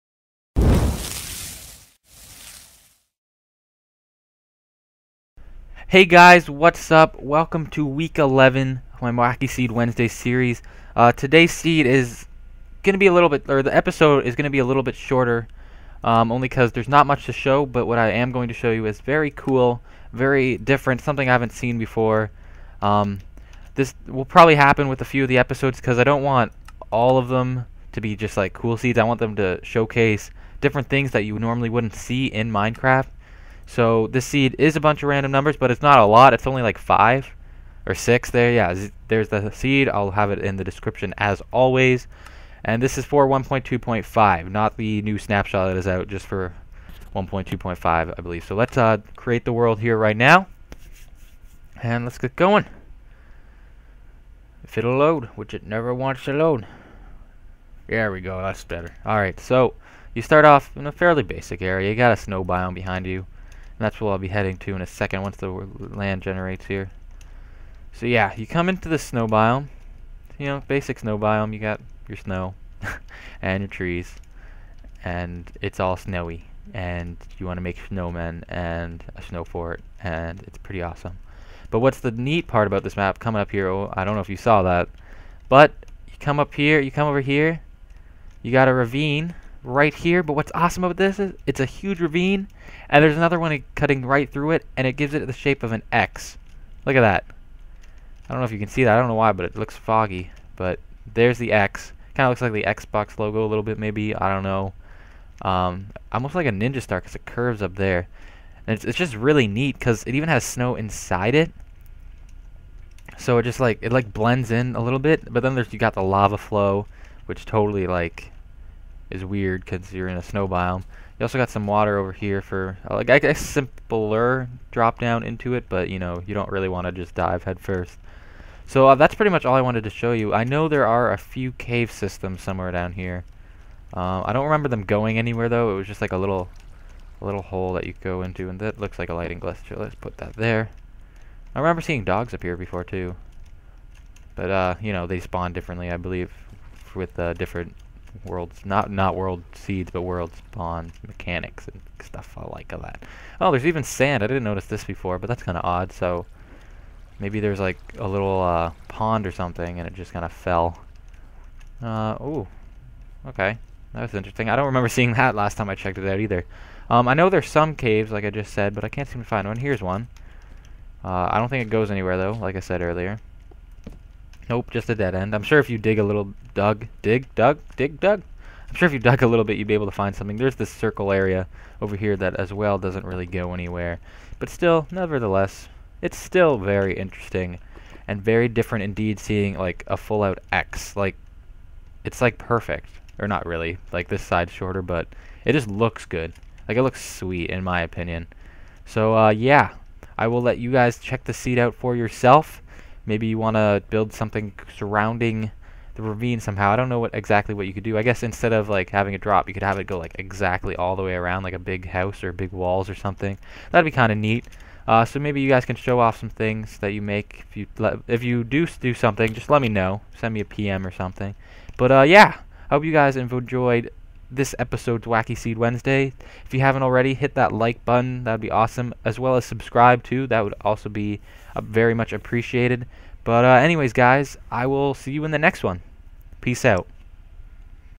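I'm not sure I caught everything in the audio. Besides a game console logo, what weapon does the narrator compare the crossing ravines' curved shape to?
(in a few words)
Ninja Star.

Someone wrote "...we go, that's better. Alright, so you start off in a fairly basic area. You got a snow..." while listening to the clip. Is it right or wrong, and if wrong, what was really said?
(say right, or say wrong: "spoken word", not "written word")
right.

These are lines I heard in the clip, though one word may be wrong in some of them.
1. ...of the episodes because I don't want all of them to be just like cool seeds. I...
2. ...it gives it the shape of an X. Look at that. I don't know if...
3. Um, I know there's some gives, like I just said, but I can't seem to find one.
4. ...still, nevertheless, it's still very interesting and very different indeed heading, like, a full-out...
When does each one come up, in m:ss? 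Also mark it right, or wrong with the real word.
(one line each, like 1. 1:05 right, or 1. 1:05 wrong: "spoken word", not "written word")
1. 0:25 right
2. 1:34 right
3. 2:46 wrong: "caves", not "gives"
4. 3:04 wrong: "seeing", not "heading".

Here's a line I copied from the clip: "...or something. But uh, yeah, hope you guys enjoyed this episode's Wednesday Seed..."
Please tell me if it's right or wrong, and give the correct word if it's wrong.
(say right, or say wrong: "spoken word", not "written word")
wrong: "Wacky", not "Wednesday".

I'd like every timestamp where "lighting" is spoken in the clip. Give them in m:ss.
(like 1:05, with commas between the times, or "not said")
2:19.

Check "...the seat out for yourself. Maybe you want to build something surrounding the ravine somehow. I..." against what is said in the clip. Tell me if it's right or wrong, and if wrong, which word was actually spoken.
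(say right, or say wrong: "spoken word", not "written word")
right.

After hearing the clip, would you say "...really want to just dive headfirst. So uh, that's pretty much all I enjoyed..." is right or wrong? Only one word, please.
wrong.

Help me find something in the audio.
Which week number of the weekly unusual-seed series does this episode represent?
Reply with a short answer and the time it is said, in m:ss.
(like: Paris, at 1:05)
11, at 0:07.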